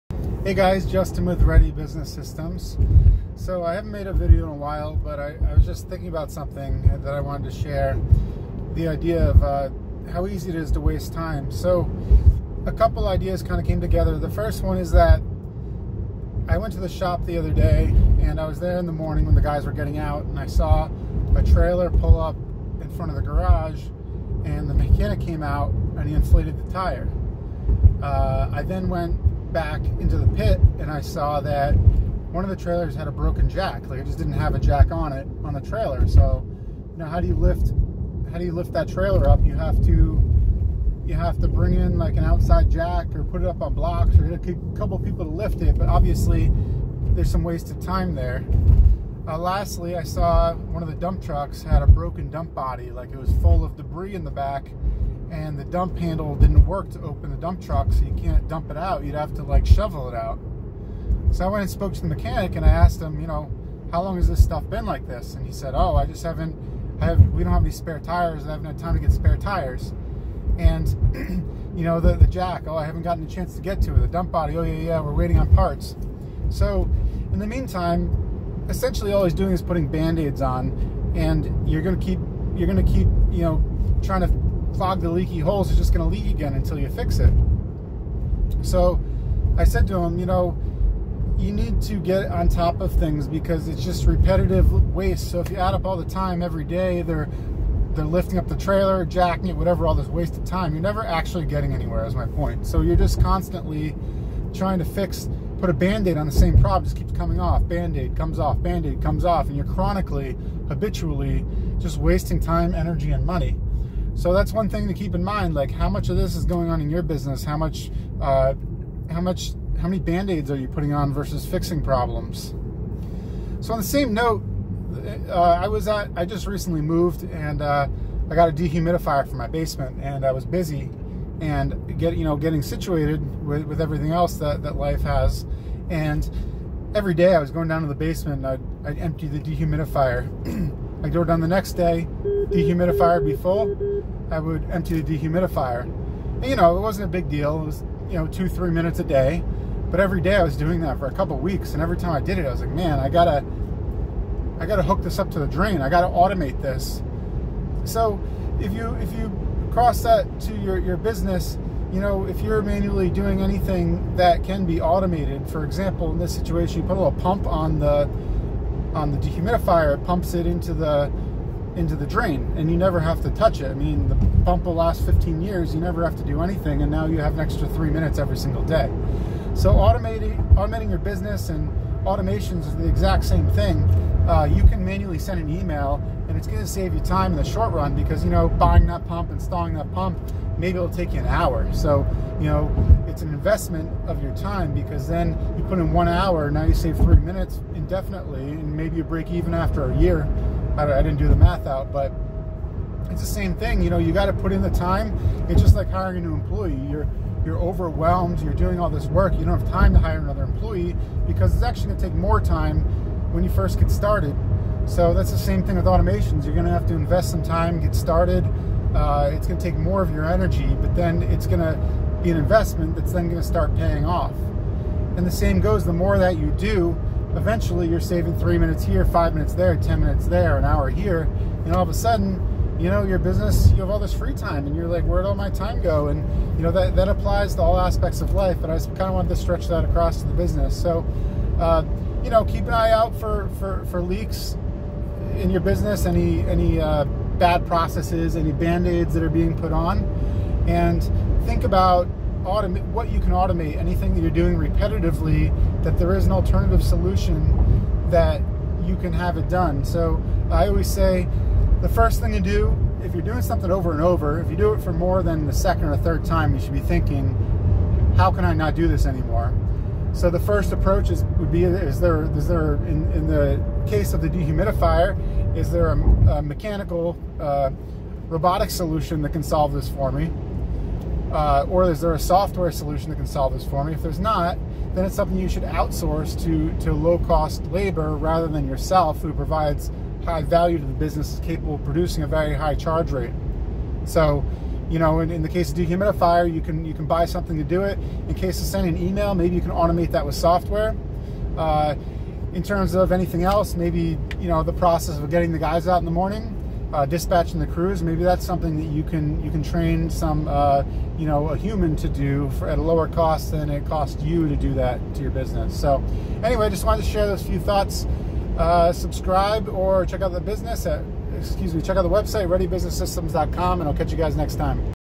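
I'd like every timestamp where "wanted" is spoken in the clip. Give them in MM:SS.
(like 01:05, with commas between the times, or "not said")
00:07, 03:59, 05:16.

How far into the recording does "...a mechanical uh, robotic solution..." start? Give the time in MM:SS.
04:36.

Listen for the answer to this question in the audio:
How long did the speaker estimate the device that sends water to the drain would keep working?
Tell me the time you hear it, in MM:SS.
02:55.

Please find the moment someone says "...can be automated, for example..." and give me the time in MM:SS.
02:44.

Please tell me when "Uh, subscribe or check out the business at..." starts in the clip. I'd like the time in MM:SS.
05:18.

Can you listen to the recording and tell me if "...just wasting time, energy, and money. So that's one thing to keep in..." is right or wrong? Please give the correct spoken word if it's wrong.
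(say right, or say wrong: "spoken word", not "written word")
right.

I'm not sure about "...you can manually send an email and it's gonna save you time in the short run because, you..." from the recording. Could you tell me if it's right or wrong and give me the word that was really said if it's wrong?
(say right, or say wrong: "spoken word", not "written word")
right.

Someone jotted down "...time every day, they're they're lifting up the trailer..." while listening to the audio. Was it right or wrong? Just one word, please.
right.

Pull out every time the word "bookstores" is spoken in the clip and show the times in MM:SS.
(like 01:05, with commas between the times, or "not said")
not said.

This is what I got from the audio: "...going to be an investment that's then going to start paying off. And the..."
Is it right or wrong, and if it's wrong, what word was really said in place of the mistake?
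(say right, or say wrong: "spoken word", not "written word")
right.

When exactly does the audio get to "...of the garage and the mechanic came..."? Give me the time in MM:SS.
00:23.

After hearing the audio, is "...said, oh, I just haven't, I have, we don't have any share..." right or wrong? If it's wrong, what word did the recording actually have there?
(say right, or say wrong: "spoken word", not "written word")
wrong: "spare", not "share".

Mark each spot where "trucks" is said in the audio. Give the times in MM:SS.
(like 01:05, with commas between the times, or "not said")
00:51, 00:57.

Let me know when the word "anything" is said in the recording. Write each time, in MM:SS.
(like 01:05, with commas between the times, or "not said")
02:43, 02:56, 04:13, 05:03.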